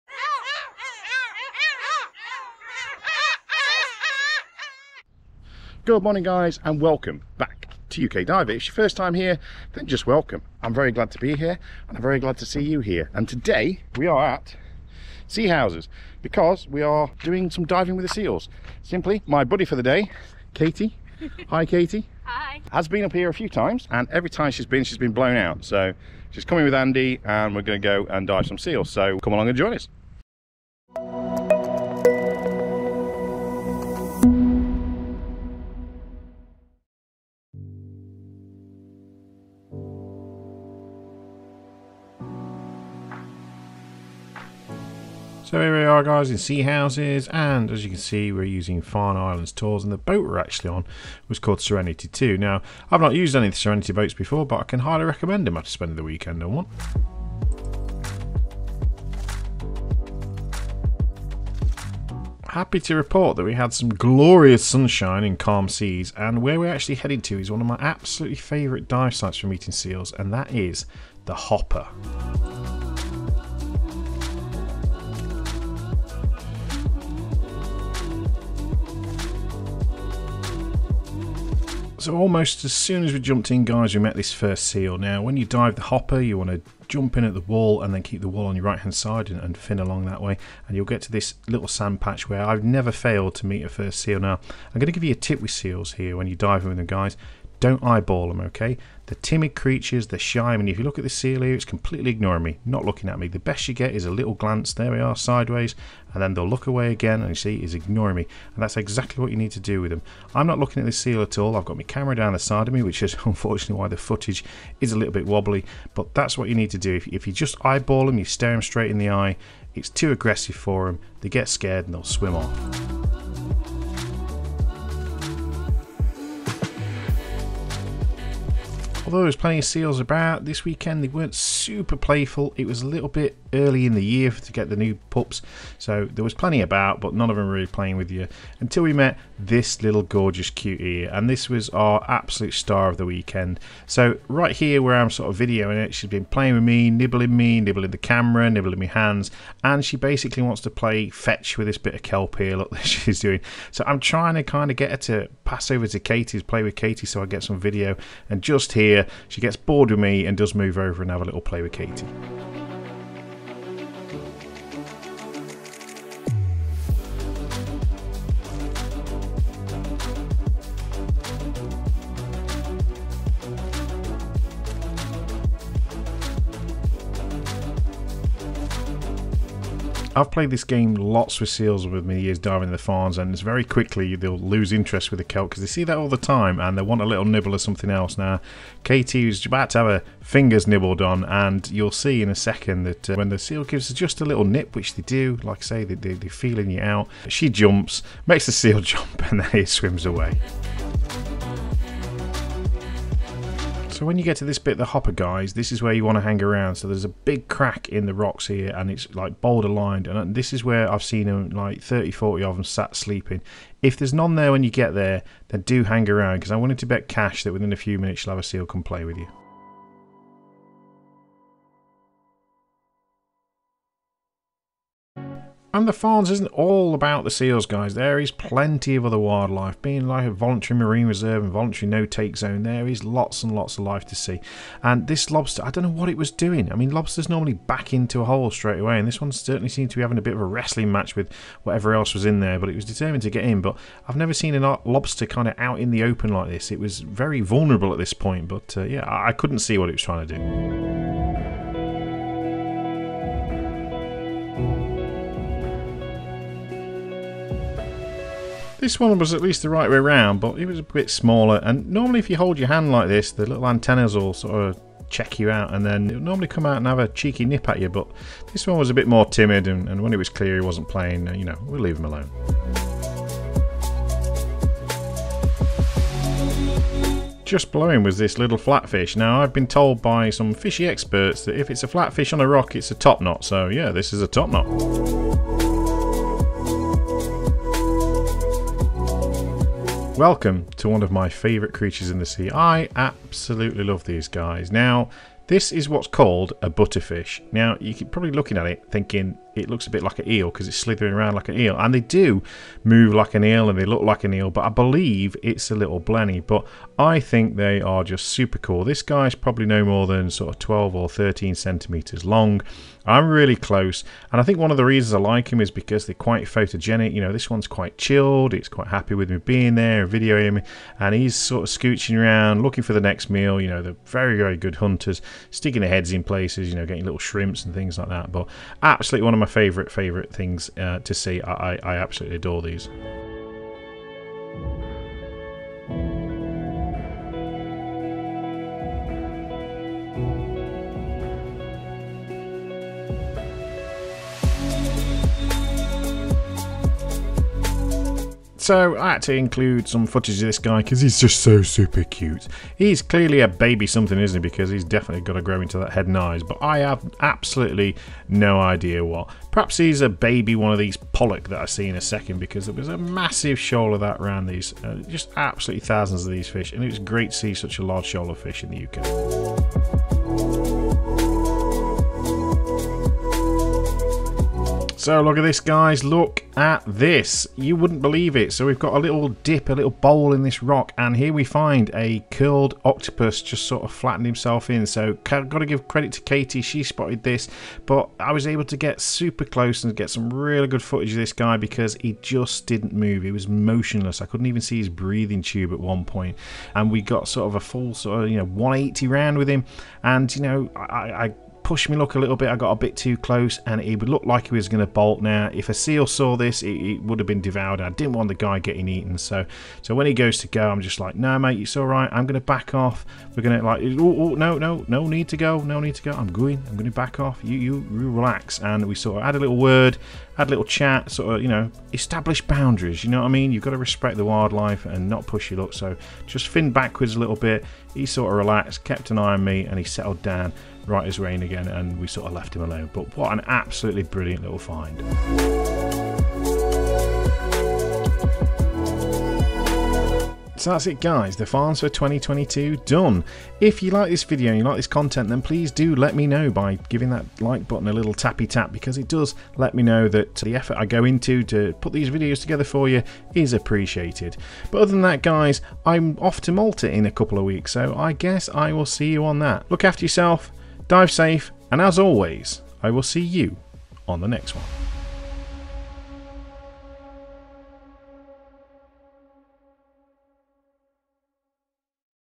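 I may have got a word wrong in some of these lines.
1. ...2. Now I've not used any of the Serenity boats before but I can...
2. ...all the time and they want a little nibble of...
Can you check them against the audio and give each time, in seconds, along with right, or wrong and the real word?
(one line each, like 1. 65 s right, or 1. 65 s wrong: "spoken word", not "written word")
1. 52 s right
2. 185 s right.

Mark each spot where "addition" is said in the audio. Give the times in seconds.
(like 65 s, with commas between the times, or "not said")
not said.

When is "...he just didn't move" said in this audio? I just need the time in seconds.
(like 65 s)
392 s.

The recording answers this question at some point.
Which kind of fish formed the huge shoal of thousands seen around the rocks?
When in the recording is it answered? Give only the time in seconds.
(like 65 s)
360 s.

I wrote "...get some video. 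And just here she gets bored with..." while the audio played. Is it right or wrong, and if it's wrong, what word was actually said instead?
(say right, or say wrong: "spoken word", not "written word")
right.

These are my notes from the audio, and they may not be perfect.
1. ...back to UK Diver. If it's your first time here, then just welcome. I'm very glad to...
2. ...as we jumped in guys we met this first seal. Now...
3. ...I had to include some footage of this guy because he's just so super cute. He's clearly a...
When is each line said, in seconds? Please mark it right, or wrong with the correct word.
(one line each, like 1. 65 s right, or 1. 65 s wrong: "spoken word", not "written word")
1. 7 s right
2. 83 s right
3. 348 s right.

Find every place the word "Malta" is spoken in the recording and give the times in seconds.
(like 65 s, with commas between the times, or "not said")
456 s.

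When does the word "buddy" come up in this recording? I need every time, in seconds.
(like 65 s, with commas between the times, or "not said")
19 s.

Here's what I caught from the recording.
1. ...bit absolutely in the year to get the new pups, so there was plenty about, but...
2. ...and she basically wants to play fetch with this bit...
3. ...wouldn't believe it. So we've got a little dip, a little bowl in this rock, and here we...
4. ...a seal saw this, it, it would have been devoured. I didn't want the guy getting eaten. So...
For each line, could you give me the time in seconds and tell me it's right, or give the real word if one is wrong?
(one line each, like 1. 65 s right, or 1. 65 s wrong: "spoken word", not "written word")
1. 133 s wrong: "early", not "absolutely"
2. 149 s right
3. 377 s right
4. 405 s right.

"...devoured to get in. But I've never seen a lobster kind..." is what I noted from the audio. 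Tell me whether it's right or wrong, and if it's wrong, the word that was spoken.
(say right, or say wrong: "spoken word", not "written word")
wrong: "determined", not "devoured".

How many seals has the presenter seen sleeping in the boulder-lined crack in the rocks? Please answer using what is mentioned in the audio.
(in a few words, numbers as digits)
30 to 40.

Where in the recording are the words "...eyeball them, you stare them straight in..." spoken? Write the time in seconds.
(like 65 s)
117 s.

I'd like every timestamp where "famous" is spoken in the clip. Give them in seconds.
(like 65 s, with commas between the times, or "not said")
not said.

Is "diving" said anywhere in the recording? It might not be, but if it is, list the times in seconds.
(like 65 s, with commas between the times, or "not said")
17 s, 182 s.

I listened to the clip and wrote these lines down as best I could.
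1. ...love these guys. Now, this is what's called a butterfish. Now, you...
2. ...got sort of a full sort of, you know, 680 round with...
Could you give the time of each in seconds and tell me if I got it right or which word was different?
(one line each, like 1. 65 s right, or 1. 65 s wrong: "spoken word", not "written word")
1. 293 s right
2. 397 s wrong: "180", not "680".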